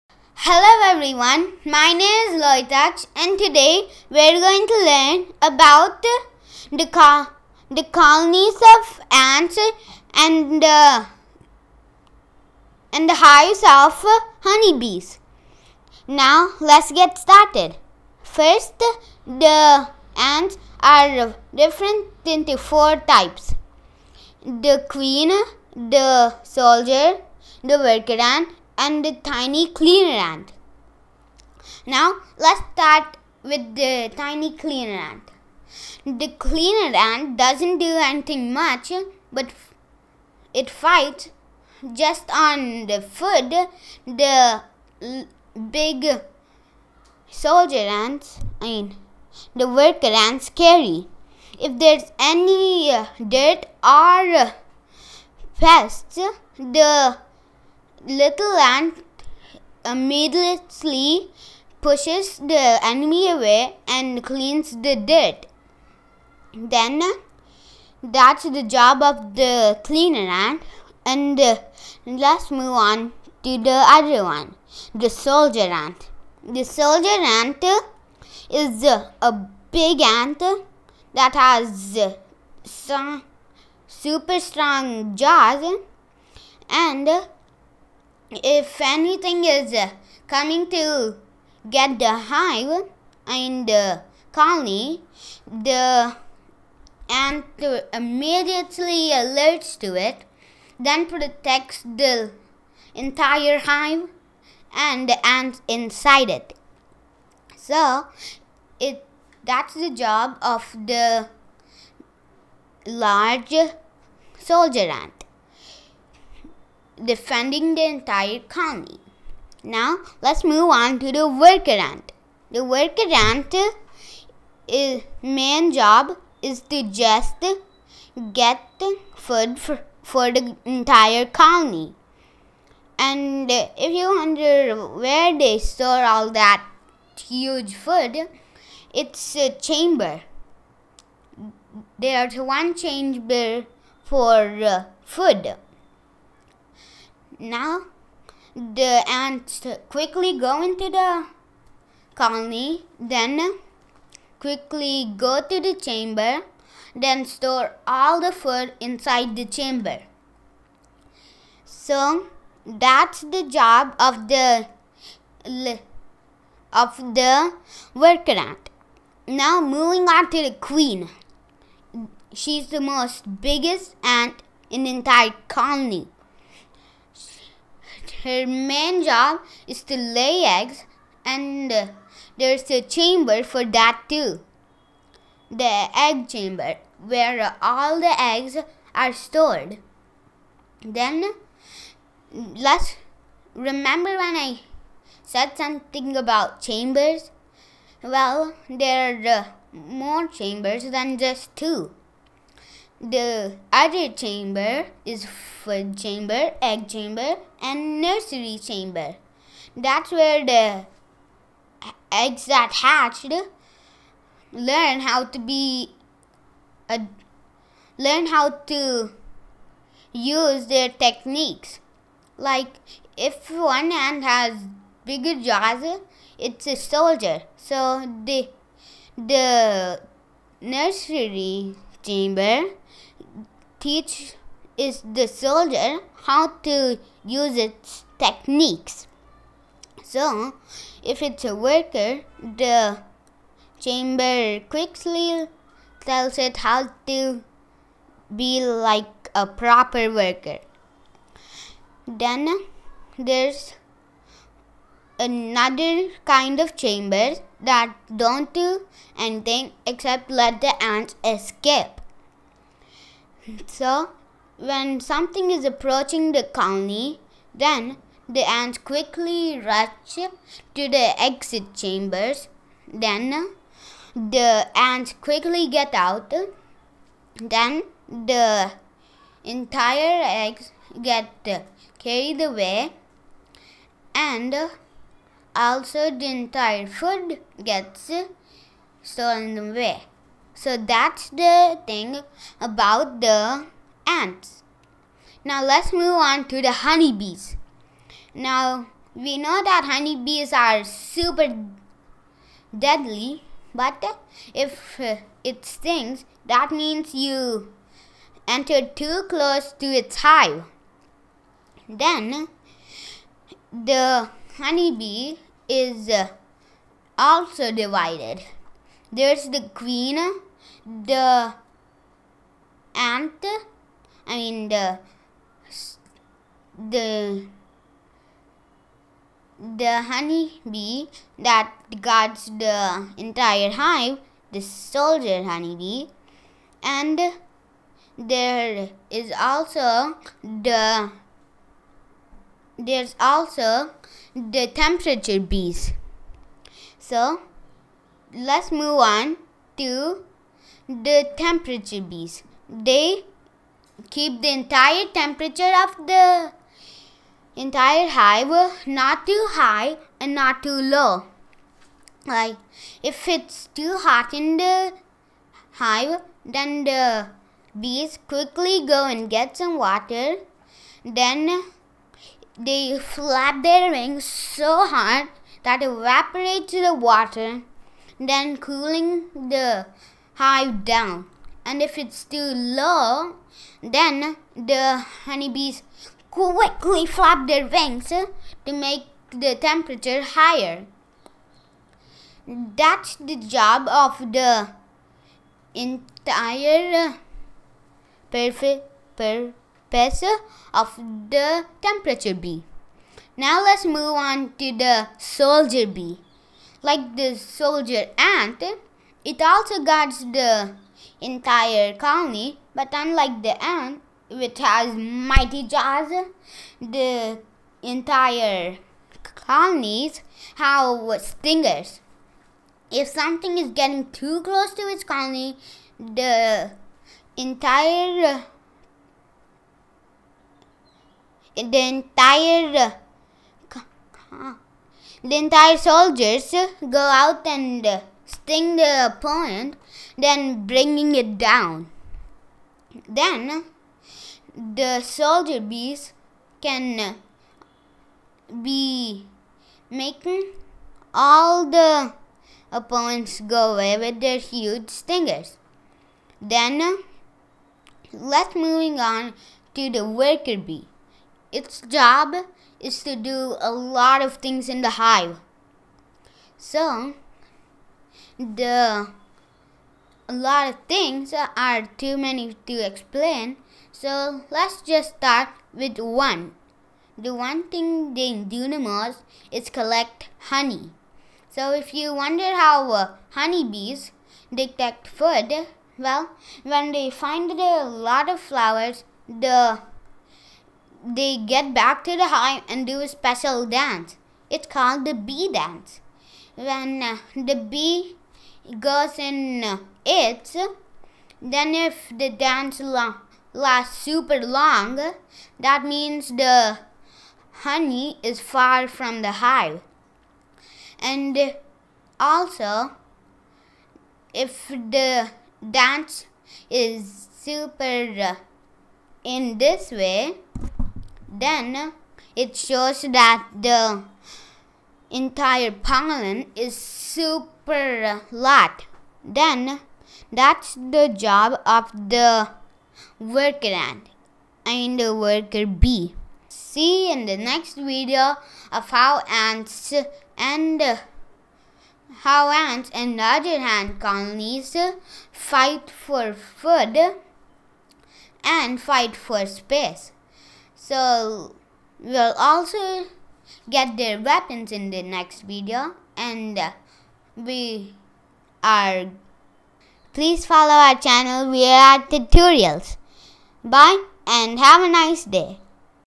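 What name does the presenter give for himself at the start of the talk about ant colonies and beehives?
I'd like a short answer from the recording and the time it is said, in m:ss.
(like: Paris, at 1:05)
Loitach, at 0:02.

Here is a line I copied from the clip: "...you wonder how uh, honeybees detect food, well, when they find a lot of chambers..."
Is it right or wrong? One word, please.
wrong.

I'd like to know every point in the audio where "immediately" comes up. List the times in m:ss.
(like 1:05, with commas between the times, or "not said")
0:59, 1:37.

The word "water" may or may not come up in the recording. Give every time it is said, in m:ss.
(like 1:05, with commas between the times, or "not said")
6:09, 6:16.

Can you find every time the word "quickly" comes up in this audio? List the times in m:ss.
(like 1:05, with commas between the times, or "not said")
2:29, 2:34, 4:04, 4:28, 4:35, 6:08, 6:26.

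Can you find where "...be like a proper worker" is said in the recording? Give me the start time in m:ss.
4:08.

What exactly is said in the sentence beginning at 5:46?
So let's move on to the temperature bees.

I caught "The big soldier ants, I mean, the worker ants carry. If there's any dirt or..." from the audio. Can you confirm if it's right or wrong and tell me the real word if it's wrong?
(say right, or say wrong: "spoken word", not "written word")
right.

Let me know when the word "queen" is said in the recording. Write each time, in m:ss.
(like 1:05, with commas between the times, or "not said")
0:24, 2:50, 5:19.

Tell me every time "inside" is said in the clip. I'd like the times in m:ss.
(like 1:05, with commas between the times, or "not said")
1:45, 2:38.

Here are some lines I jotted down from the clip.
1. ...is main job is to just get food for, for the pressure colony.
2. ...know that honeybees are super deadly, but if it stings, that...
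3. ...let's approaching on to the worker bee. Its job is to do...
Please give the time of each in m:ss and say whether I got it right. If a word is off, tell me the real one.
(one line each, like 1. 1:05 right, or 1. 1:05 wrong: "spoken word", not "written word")
1. 2:04 wrong: "entire", not "pressure"
2. 4:59 right
3. 7:38 wrong: "moving", not "approaching".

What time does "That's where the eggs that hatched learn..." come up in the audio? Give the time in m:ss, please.
3:29.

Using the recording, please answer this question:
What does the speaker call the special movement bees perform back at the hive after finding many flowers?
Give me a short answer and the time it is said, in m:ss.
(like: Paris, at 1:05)
the bee dance, at 8:15.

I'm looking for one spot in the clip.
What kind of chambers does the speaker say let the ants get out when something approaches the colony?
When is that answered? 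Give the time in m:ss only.
4:31.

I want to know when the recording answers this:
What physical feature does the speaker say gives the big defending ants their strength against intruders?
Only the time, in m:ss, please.
1:23.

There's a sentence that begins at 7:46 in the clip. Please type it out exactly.
So, the a lot of things are too many to explain.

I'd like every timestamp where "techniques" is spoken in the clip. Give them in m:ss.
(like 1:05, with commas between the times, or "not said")
3:40, 3:58.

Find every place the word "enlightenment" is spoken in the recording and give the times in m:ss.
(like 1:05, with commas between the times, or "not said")
not said.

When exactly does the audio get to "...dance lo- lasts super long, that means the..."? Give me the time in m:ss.
8:22.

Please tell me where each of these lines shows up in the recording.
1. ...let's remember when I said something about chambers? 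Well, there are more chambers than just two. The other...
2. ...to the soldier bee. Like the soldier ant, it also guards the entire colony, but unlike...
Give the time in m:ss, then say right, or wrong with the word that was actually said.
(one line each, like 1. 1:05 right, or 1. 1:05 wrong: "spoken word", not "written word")
1. 3:12 right
2. 6:44 right.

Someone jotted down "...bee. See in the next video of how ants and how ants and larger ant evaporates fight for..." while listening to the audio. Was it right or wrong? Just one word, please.
wrong.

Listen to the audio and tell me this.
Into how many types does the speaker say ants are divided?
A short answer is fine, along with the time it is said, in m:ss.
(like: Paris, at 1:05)
4, at 0:22.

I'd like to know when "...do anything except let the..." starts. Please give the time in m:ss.
4:18.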